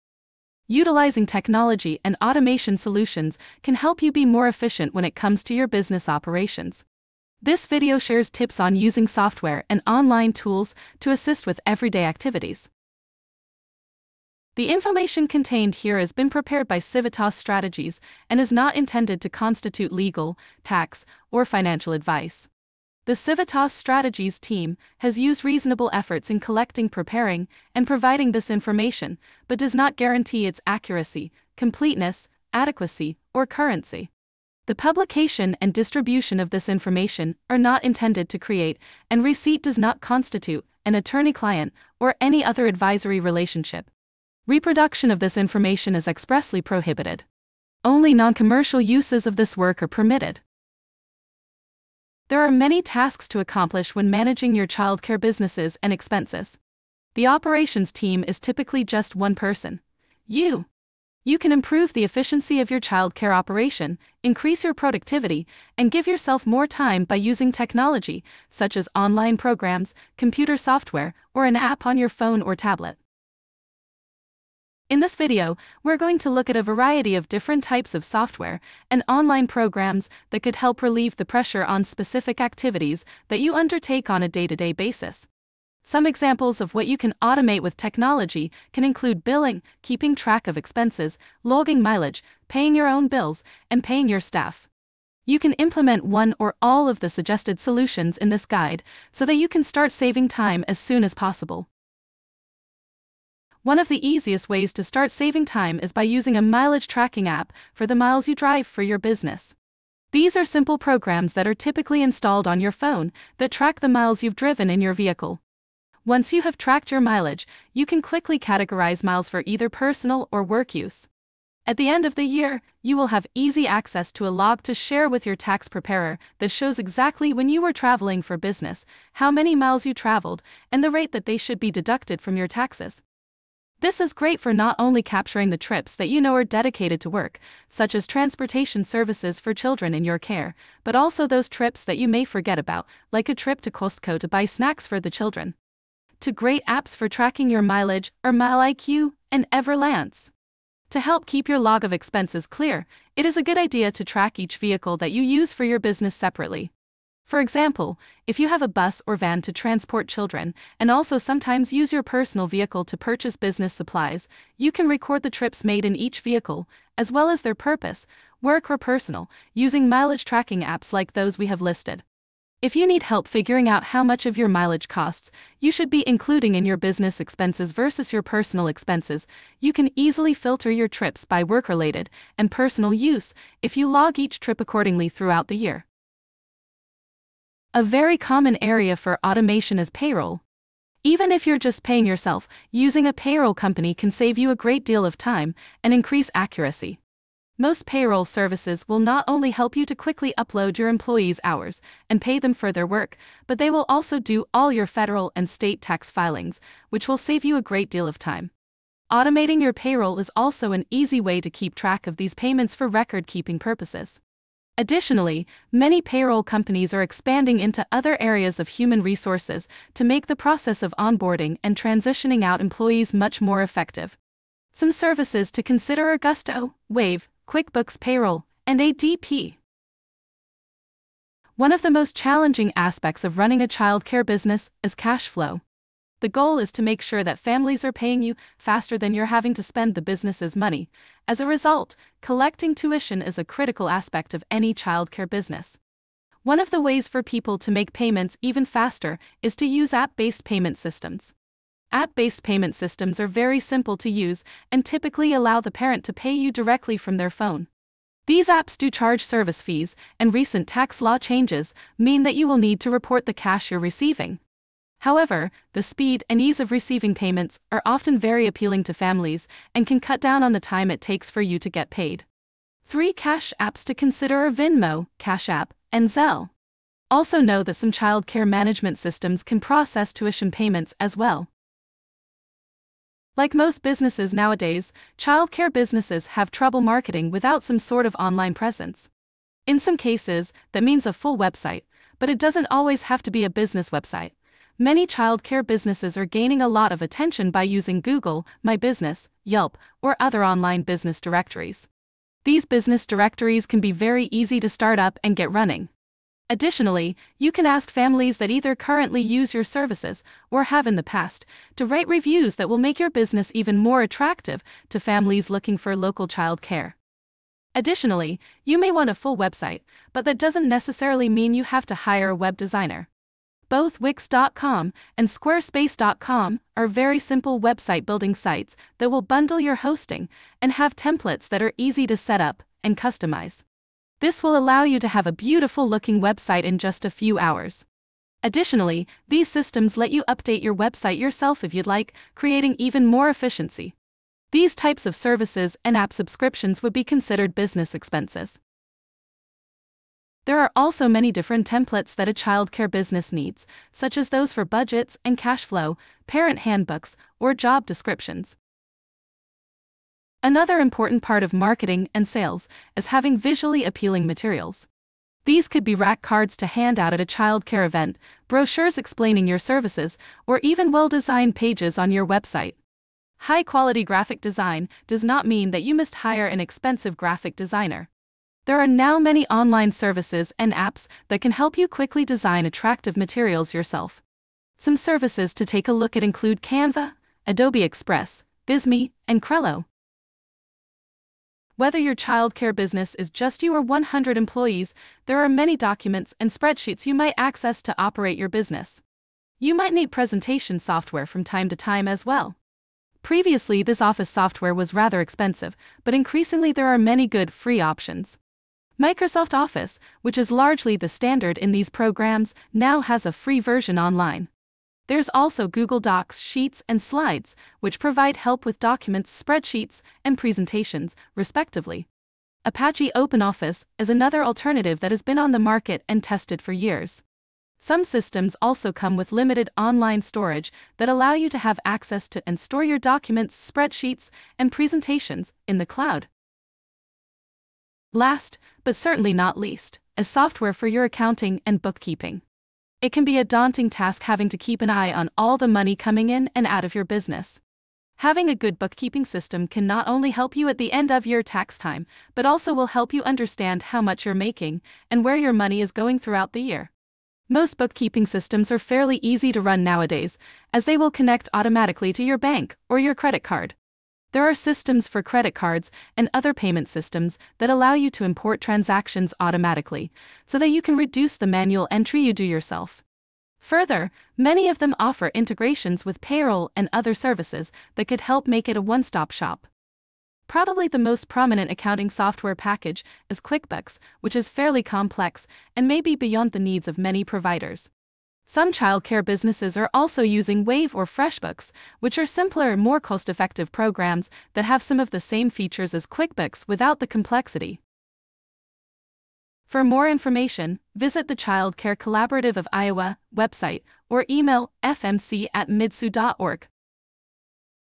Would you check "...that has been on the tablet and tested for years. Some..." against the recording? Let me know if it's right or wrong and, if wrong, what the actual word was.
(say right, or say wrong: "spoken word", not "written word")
wrong: "market", not "tablet".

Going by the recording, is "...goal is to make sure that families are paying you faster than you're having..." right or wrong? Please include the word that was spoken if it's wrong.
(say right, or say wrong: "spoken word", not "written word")
right.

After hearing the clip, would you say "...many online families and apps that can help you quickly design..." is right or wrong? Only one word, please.
wrong.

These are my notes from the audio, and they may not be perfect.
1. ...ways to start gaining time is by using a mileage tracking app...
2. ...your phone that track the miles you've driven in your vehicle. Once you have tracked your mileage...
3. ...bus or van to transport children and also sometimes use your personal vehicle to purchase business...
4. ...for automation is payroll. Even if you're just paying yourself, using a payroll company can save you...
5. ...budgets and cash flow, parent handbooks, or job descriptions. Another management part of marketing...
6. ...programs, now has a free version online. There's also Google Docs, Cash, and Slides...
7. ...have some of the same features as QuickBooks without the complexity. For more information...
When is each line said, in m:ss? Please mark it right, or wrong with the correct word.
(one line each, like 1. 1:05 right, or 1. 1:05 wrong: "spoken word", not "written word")
1. 1:44 wrong: "saving", not "gaining"
2. 1:52 right
3. 2:38 right
4. 3:08 right
5. 5:54 wrong: "important", not "management"
6. 6:51 wrong: "Sheets", not "Cash"
7. 8:14 right.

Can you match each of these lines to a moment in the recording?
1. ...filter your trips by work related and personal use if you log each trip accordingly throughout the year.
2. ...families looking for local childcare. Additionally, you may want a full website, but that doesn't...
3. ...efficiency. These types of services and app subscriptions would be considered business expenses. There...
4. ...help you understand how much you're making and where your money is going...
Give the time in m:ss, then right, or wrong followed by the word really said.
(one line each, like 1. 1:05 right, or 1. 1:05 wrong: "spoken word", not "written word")
1. 3:00 right
2. 5:14 right
3. 5:43 right
4. 7:32 right.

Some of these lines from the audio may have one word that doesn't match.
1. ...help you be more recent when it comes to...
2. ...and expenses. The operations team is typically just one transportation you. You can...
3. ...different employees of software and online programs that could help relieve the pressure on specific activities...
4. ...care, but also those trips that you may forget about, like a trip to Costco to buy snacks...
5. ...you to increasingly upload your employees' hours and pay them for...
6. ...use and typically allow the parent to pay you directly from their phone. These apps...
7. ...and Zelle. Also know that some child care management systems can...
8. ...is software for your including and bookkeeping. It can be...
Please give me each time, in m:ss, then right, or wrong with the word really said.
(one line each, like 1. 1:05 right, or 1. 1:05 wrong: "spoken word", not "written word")
1. 0:03 wrong: "efficient", not "recent"
2. 0:55 wrong: "person", not "transportation"
3. 1:17 wrong: "types", not "employees"
4. 2:20 right
5. 3:19 wrong: "quickly", not "increasingly"
6. 4:14 right
7. 4:35 right
8. 7:20 wrong: "accounting", not "including".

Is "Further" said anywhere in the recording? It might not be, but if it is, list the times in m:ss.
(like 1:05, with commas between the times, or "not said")
7:53.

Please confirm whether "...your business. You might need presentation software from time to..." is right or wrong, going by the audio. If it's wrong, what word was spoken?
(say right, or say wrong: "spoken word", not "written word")
right.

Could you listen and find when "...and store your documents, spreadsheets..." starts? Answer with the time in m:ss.
7:12.